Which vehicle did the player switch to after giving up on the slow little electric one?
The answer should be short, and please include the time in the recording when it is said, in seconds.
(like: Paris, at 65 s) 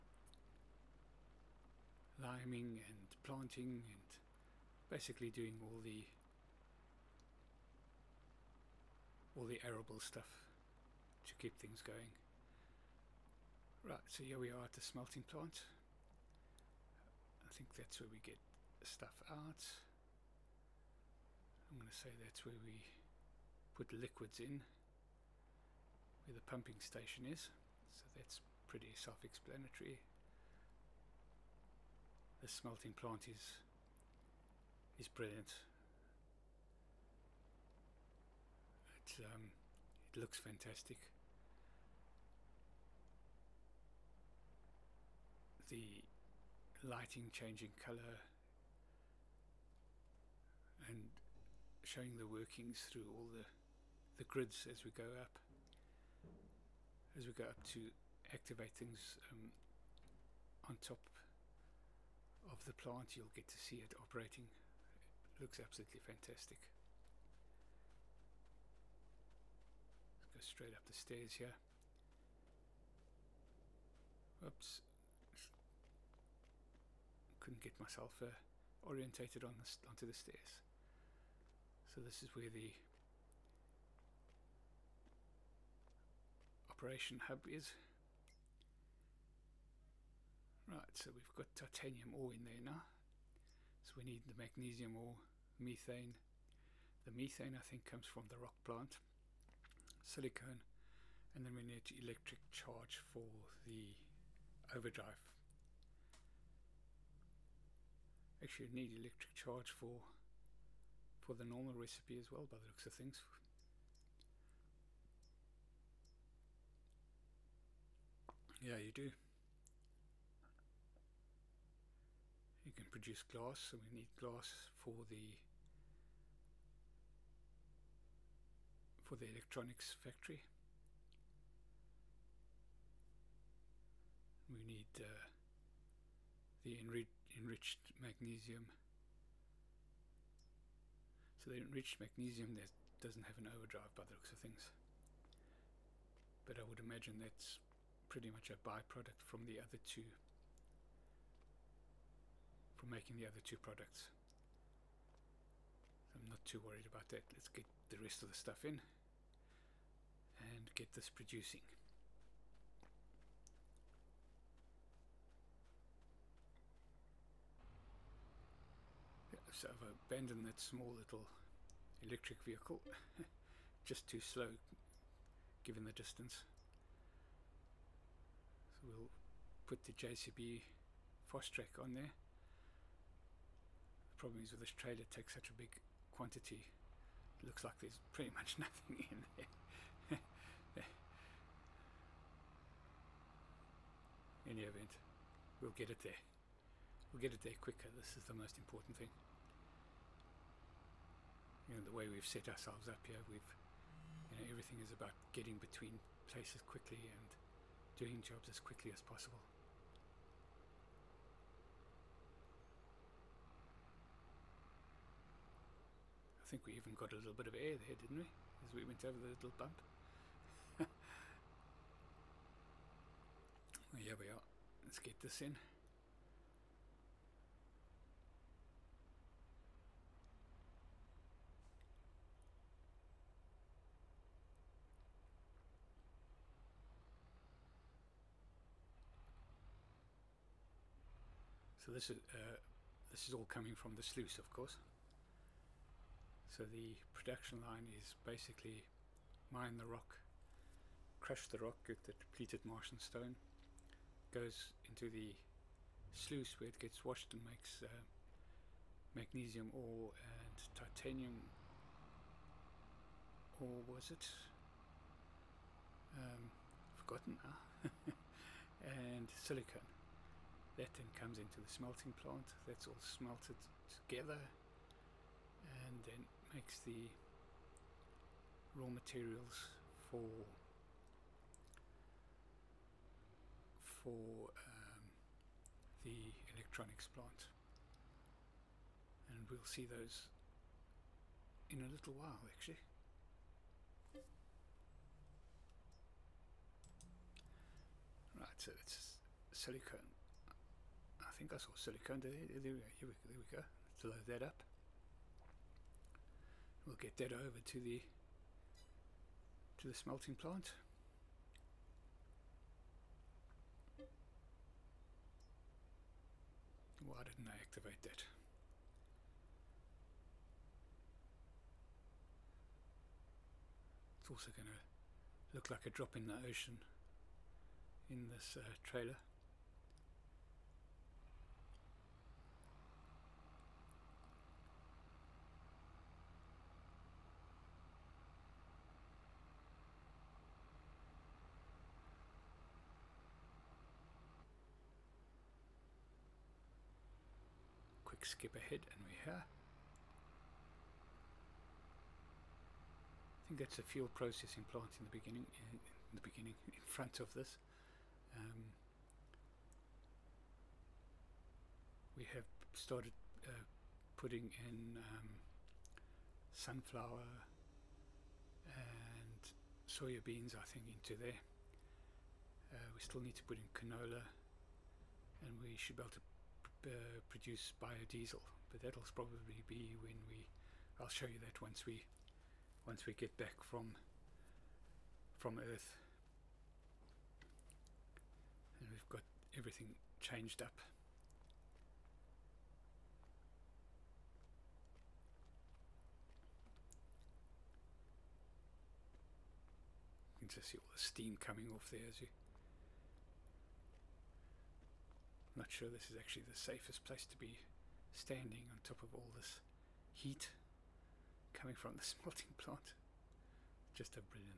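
JCB Fast Track, at 179 s.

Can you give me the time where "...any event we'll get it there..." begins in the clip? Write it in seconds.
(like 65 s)
194 s.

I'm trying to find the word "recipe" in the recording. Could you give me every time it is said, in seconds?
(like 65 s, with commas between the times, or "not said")
111 s.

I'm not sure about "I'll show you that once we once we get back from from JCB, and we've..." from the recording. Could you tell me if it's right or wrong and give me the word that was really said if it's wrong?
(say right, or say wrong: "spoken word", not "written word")
wrong: "Earth", not "JCB".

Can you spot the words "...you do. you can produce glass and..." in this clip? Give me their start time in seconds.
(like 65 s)
118 s.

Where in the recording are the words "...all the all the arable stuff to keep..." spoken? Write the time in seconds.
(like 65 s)
5 s.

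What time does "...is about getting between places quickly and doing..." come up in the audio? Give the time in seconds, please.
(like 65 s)
204 s.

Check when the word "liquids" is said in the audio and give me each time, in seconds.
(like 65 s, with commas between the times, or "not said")
23 s.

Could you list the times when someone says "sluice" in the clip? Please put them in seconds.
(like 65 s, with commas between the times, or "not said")
244 s, 256 s.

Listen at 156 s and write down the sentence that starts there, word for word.
I'm not too worried about that.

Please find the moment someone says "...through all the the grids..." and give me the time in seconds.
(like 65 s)
52 s.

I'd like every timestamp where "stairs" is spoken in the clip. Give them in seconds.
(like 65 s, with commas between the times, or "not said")
70 s, 80 s.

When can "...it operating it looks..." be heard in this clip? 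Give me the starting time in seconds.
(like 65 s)
63 s.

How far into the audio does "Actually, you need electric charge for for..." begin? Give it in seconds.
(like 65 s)
108 s.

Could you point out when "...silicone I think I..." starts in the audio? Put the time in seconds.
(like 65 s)
299 s.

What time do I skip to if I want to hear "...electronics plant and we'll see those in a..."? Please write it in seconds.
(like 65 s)
286 s.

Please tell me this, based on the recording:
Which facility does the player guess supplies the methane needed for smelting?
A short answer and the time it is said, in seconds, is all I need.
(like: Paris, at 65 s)
The rock plant, at 98 s.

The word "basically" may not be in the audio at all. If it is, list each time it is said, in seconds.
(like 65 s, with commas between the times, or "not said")
4 s, 248 s.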